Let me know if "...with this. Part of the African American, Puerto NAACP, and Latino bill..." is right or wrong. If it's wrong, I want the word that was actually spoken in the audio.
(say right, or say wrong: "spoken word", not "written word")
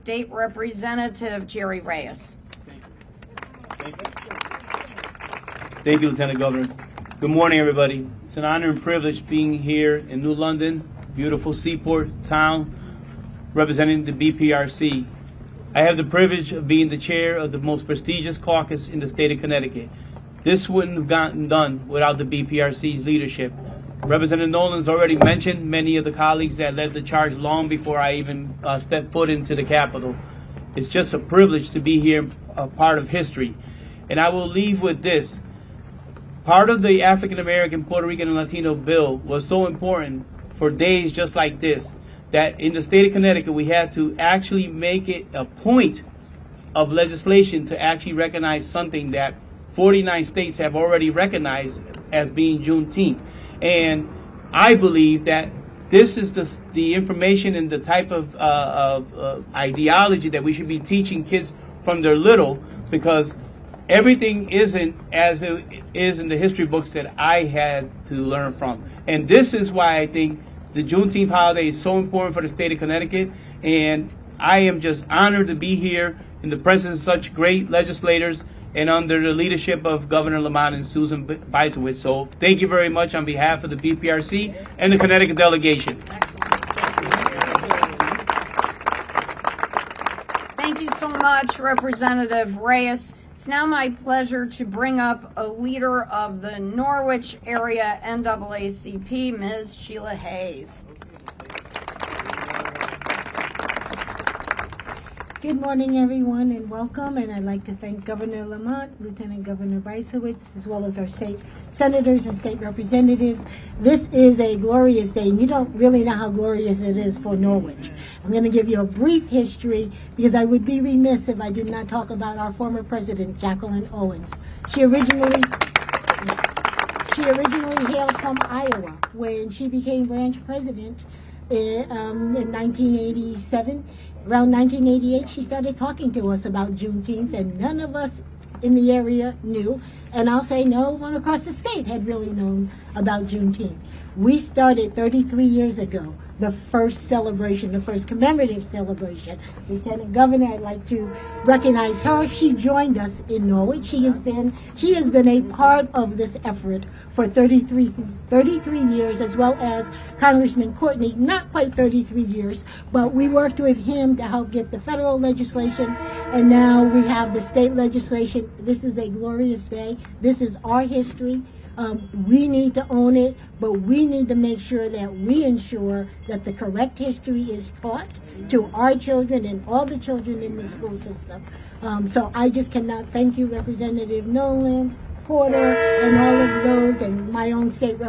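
wrong: "Rican", not "NAACP".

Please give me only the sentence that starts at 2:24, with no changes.
We started 33 years ago the first celebration, the first commemorative celebration.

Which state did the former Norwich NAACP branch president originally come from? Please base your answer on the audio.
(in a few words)
Iowa.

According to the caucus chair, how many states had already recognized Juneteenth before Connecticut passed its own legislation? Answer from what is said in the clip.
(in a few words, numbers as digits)
49.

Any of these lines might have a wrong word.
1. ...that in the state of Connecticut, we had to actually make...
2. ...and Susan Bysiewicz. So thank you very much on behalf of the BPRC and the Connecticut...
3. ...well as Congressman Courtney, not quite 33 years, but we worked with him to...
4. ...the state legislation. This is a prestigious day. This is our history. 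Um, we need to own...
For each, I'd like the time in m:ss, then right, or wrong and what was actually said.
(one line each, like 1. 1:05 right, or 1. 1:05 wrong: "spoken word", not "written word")
1. 0:42 right
2. 1:20 right
3. 2:39 right
4. 2:47 wrong: "glorious", not "prestigious".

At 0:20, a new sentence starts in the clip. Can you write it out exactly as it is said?
This wouldn't have gotten done without the BPRC's leadership.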